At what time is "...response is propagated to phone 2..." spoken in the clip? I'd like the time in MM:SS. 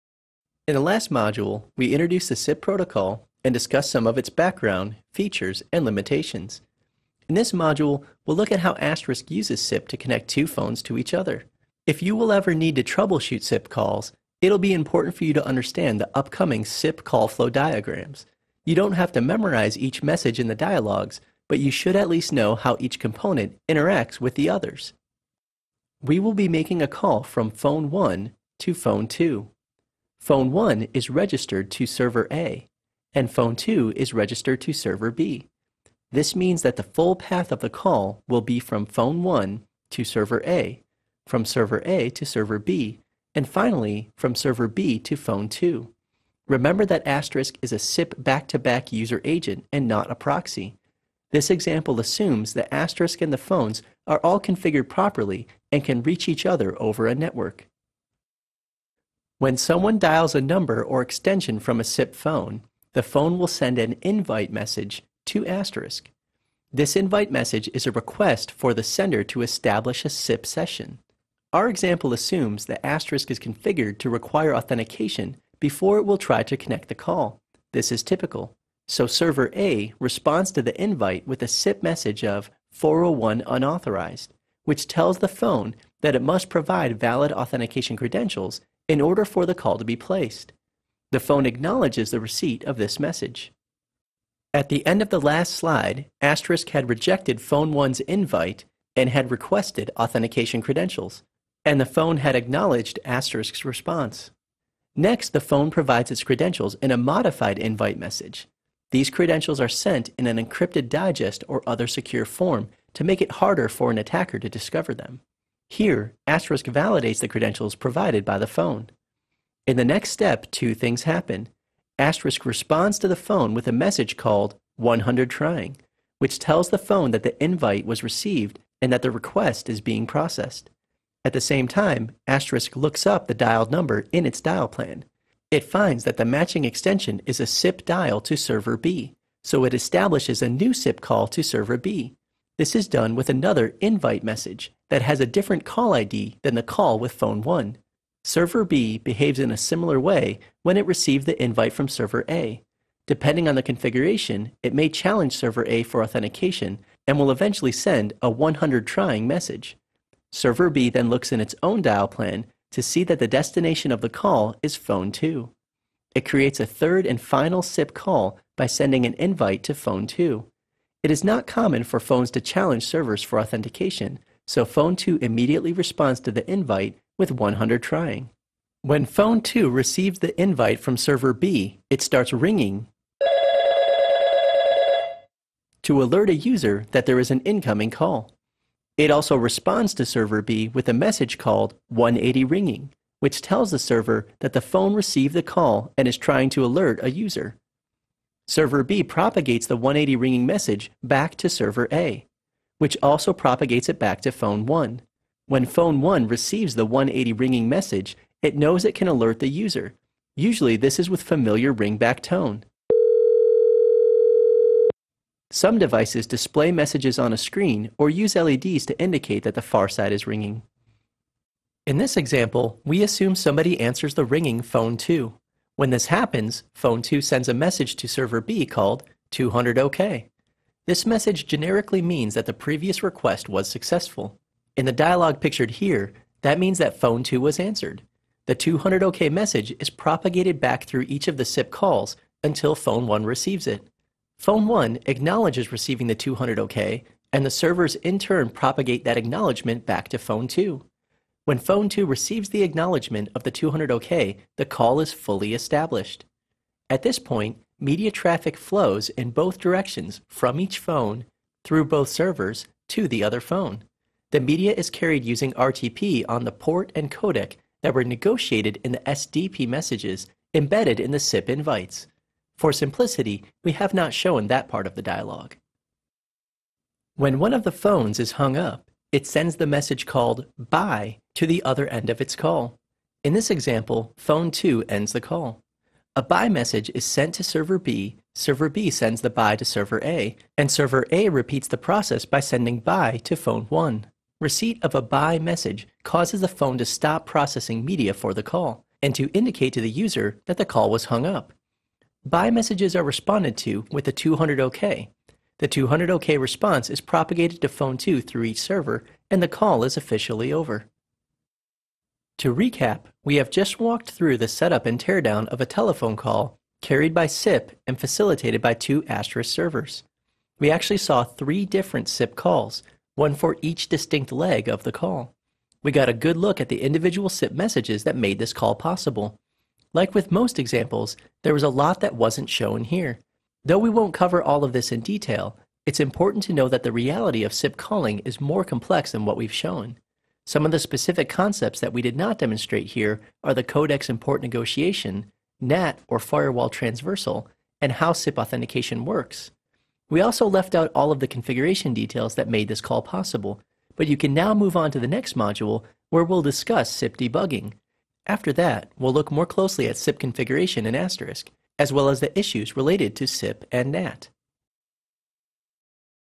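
05:06.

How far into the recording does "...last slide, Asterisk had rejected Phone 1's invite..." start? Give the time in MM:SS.
01:35.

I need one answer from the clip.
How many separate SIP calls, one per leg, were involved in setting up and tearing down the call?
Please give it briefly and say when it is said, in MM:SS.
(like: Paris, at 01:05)
3, at 05:21.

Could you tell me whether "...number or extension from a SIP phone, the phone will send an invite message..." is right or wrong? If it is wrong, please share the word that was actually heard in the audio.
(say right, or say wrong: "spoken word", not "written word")
right.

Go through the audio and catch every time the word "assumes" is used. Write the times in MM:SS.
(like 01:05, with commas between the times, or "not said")
00:51, 01:12, 03:43.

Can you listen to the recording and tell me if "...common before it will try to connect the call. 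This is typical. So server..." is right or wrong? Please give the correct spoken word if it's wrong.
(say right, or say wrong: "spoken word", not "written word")
wrong: "authentication", not "common".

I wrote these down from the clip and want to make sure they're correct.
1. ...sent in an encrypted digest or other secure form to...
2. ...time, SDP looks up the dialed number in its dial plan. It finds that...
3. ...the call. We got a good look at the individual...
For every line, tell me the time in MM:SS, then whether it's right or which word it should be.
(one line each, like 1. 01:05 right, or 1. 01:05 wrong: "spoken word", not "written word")
1. 01:49 right
2. 02:11 wrong: "Asterisk", not "SDP"
3. 05:24 right.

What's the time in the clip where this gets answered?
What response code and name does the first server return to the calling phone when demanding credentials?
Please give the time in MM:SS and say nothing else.
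01:22.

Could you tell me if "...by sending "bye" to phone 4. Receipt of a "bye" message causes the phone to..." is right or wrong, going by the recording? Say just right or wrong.
wrong.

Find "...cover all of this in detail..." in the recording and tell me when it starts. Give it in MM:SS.
05:34.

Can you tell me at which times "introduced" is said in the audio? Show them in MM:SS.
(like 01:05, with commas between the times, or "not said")
00:01.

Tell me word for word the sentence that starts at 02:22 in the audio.
This is done with another invite message that has a different call ID than the call with phone 1.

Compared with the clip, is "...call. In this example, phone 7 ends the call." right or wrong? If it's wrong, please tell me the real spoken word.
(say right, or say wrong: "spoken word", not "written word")
wrong: "2", not "7".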